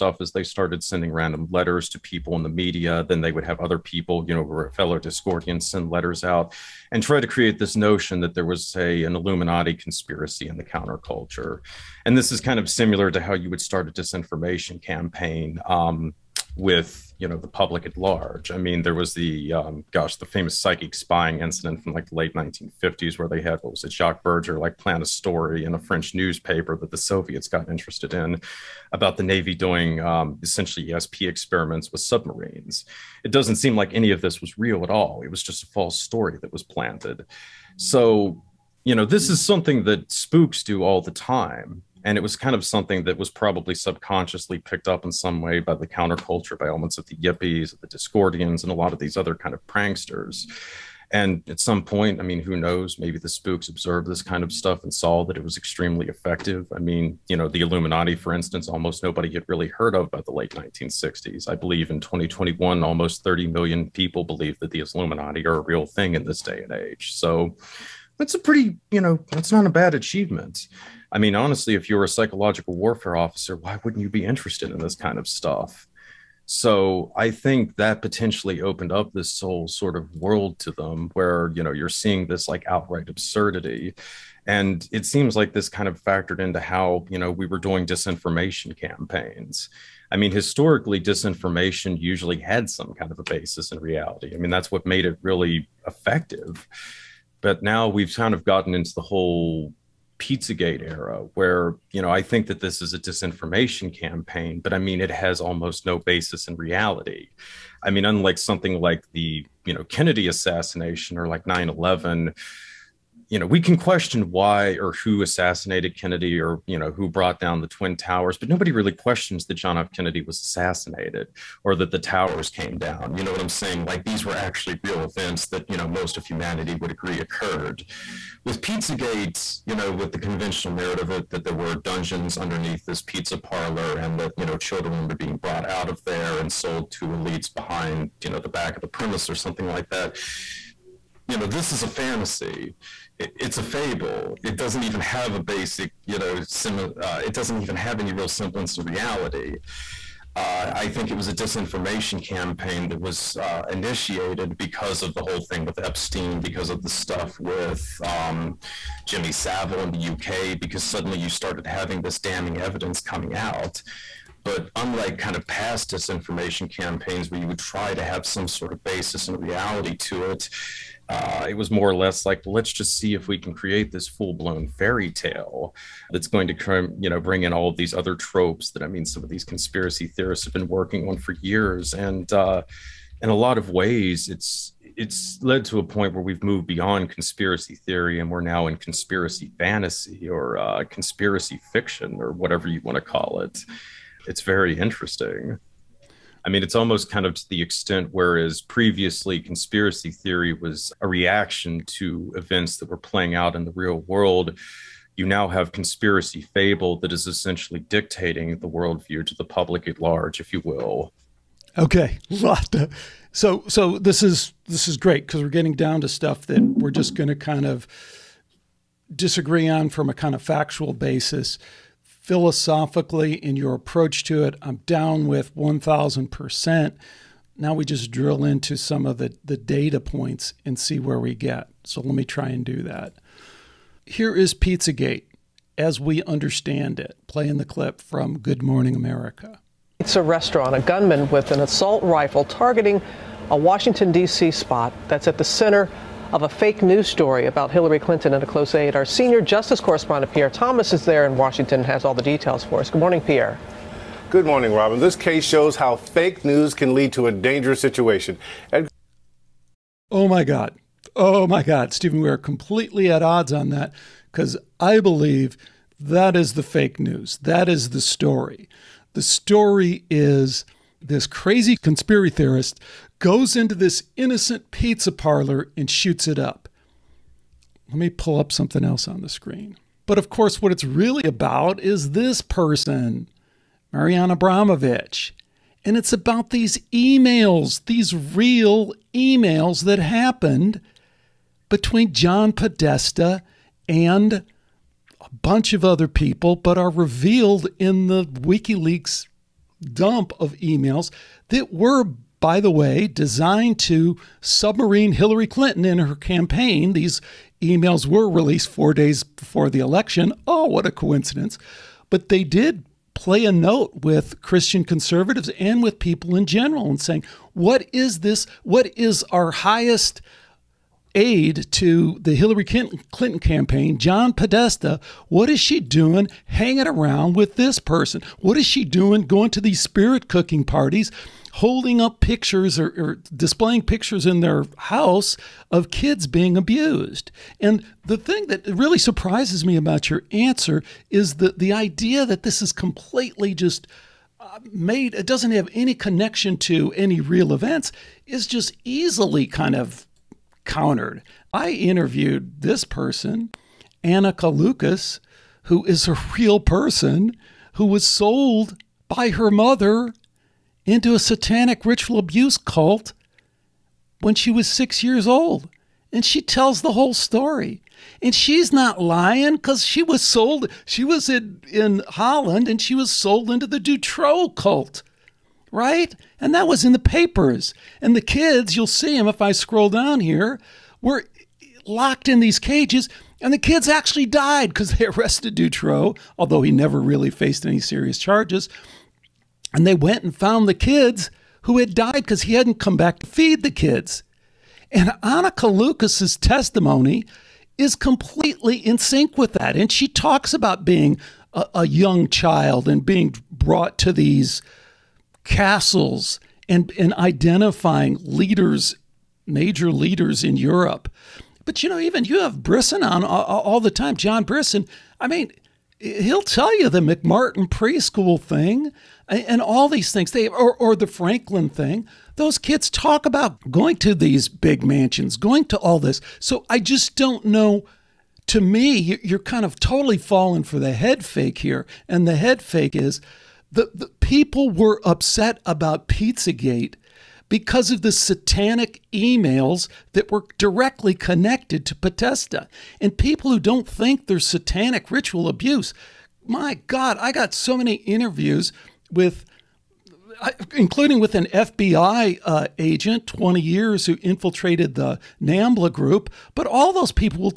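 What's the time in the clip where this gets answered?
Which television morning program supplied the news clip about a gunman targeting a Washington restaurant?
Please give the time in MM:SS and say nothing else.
03:58.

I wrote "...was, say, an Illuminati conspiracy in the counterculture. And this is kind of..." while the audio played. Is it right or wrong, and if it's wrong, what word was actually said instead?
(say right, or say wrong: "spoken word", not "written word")
right.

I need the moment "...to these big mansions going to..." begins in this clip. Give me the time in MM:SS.
07:03.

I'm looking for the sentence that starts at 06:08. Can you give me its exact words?
And she's not lying because she was sold, she was in, in Holland and she was sold into the Dutroux cult, right?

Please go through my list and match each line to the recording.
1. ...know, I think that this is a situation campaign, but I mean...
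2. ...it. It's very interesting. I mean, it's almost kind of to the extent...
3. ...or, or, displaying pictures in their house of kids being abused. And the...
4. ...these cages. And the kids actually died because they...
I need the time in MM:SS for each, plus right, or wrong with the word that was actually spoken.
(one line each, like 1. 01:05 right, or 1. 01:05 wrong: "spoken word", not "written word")
1. 01:42 wrong: "disinformation", not "situation"
2. 03:13 right
3. 05:32 right
4. 06:22 right.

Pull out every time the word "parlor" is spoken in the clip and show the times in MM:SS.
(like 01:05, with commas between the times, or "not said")
02:13, 04:35.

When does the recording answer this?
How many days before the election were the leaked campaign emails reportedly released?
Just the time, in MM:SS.
05:08.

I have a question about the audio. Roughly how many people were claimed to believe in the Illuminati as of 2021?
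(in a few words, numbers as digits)
almost 30 million.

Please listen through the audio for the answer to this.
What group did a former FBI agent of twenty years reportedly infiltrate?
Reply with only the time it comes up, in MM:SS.
07:35.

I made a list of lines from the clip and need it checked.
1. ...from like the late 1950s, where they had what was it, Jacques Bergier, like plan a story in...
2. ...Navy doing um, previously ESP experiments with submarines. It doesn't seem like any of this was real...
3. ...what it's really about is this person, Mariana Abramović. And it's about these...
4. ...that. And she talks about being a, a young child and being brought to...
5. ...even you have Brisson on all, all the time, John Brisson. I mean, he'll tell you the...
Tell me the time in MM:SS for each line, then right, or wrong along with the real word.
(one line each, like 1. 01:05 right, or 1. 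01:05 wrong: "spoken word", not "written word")
1. 00:21 right
2. 00:29 wrong: "essentially", not "previously"
3. 04:40 right
4. 06:39 right
5. 06:51 right.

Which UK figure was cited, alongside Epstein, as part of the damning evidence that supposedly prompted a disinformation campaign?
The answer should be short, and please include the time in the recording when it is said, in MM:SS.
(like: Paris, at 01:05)
Jimmy Savile, at 02:39.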